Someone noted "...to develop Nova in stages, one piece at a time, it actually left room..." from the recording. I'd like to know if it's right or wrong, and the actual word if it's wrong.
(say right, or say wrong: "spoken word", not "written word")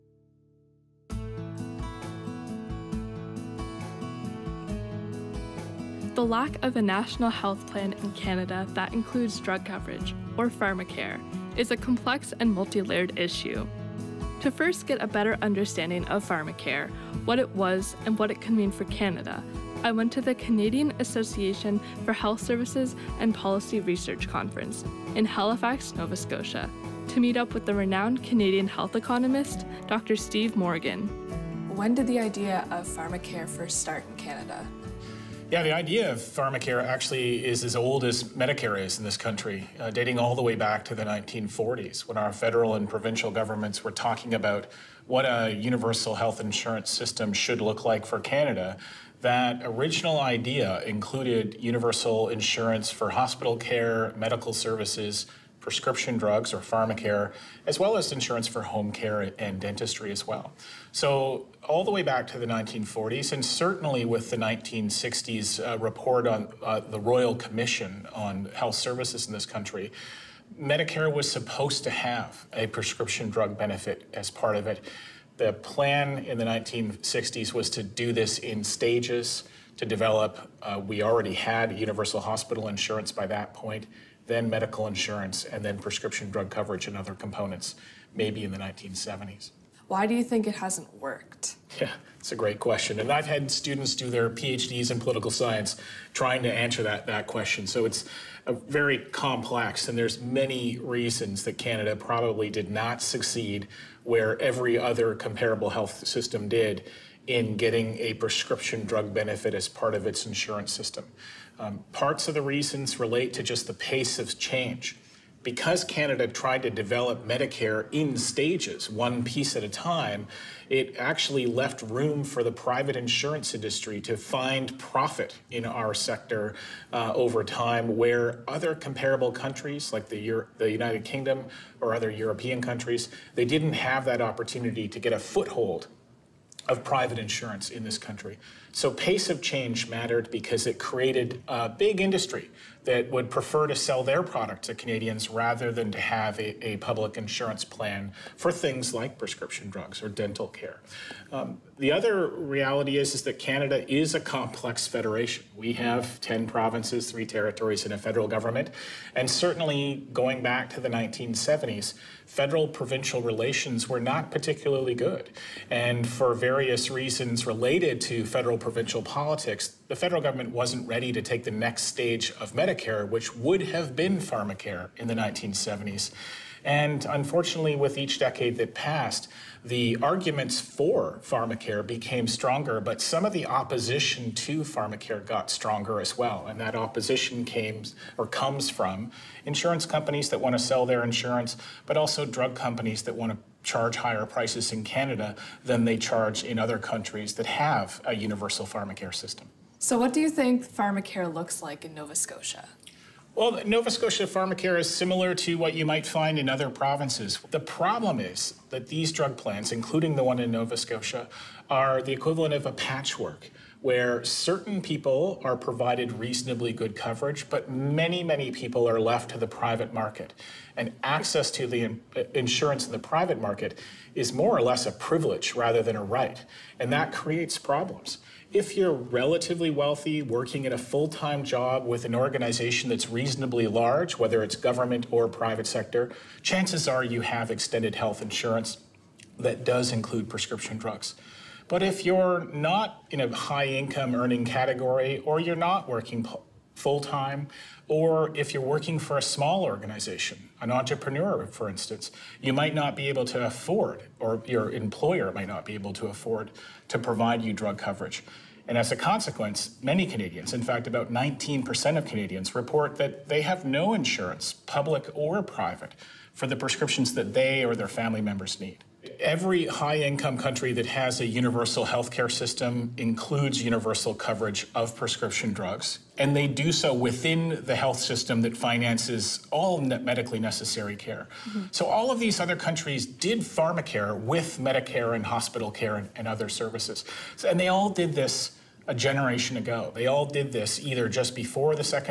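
wrong: "Medicare", not "Nova".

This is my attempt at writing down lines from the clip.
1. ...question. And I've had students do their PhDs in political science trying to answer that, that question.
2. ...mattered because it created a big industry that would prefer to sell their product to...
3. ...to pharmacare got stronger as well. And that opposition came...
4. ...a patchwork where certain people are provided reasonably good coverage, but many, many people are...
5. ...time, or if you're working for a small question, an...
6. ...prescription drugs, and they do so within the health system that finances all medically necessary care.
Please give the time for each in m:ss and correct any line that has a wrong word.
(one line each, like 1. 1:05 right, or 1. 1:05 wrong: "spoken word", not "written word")
1. 1:32 right
2. 2:19 right
3. 3:04 right
4. 3:32 right
5. 4:07 wrong: "organization", not "question"
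6. 4:34 right.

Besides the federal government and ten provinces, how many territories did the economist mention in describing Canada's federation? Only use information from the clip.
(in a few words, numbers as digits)
3.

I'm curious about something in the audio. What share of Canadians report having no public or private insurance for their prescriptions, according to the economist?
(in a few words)
19%.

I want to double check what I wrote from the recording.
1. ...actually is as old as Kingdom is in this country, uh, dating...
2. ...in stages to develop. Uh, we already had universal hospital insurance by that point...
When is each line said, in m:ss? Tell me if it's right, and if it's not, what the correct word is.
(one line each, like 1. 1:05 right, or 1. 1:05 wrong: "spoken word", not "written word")
1. 0:36 wrong: "Medicare", not "Kingdom"
2. 1:18 right.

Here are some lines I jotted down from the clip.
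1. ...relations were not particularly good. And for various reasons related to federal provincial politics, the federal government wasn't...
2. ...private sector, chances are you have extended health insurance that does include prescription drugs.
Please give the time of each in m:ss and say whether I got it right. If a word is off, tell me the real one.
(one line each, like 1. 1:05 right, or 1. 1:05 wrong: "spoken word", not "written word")
1. 2:43 right
2. 3:55 right.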